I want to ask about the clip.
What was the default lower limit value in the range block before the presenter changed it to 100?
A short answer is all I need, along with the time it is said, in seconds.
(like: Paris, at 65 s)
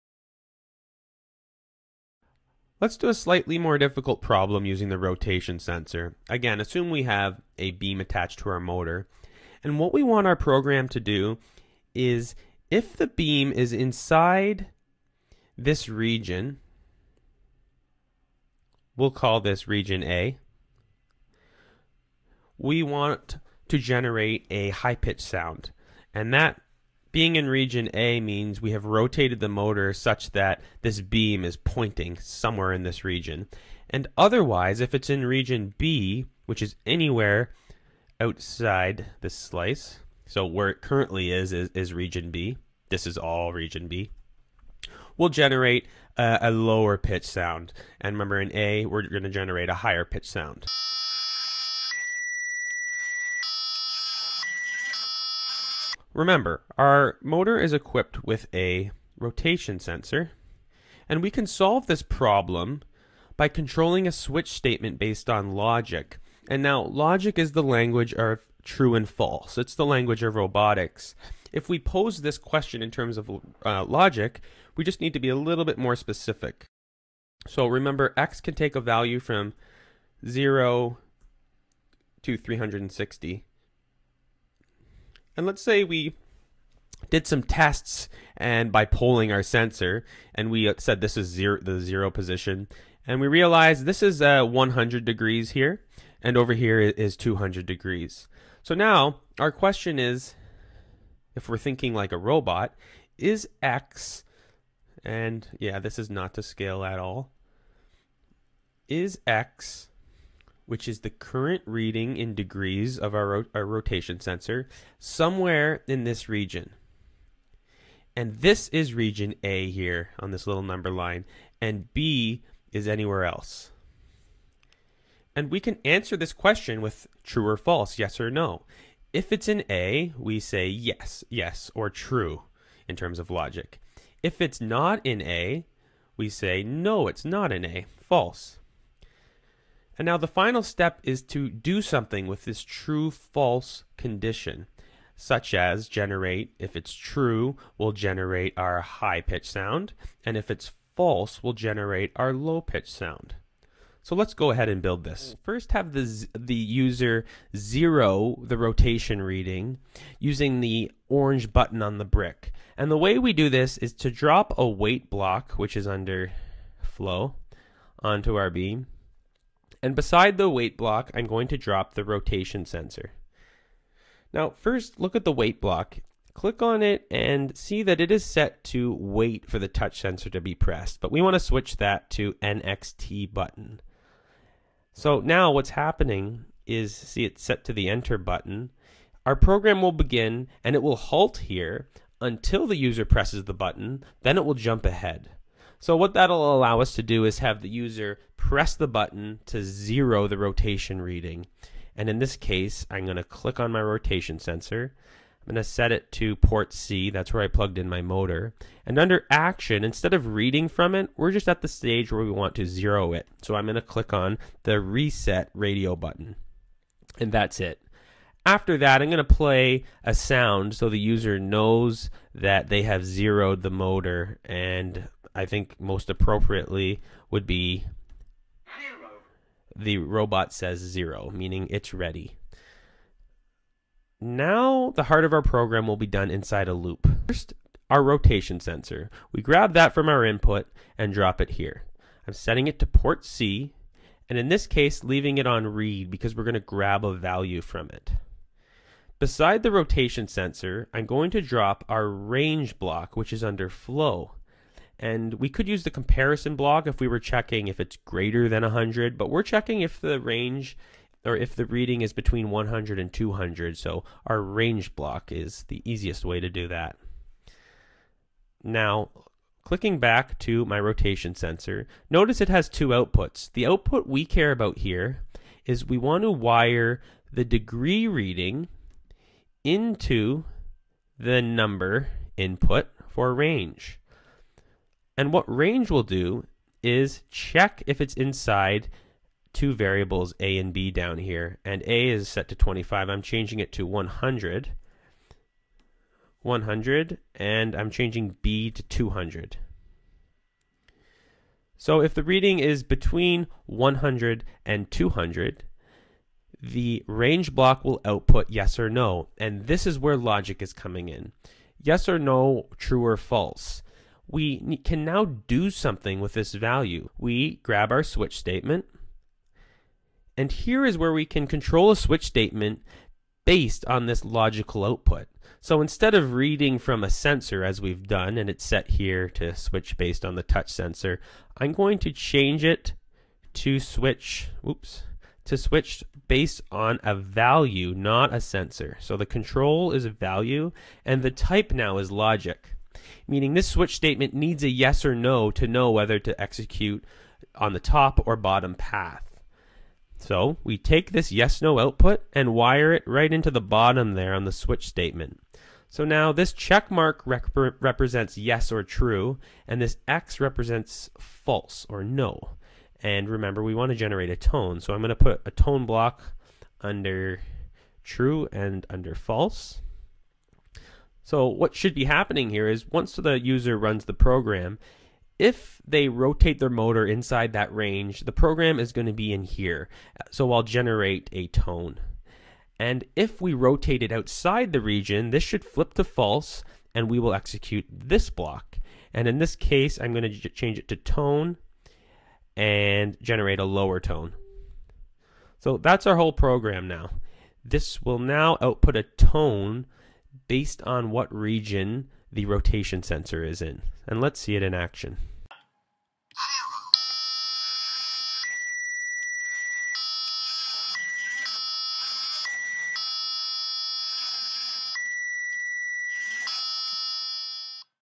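25, at 292 s.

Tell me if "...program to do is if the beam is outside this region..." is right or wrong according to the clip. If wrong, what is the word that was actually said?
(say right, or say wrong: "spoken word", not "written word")
wrong: "inside", not "outside".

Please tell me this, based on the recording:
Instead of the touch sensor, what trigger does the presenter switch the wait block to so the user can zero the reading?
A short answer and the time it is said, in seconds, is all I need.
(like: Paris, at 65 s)
NXT button, at 182 s.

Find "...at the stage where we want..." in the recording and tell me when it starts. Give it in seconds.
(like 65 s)
211 s.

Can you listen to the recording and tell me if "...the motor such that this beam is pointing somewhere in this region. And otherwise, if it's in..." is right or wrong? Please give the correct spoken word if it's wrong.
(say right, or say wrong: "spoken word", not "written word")
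right.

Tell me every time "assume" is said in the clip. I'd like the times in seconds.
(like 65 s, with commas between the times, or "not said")
6 s.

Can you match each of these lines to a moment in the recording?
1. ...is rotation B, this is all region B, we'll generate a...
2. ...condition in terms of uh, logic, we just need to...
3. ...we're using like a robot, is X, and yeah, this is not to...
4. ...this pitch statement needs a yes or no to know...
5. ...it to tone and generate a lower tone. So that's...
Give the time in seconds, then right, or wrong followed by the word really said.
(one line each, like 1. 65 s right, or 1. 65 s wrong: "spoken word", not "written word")
1. 41 s wrong: "region", not "rotation"
2. 72 s wrong: "question", not "condition"
3. 101 s wrong: "thinking", not "using"
4. 343 s wrong: "switch", not "pitch"
5. 390 s right.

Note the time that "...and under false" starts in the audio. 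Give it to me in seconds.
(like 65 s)
368 s.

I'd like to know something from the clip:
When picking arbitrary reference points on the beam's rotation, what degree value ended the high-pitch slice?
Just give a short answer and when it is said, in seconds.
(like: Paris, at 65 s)
200, at 97 s.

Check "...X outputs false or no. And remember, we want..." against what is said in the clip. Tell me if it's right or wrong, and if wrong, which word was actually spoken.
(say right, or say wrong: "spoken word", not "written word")
wrong: "represents", not "outputs".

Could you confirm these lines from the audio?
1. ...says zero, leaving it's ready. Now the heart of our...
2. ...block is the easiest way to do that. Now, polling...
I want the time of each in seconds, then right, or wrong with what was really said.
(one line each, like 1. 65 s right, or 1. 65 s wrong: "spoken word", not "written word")
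1. 230 s wrong: "meaning", not "leaving"
2. 264 s wrong: "clicking", not "polling".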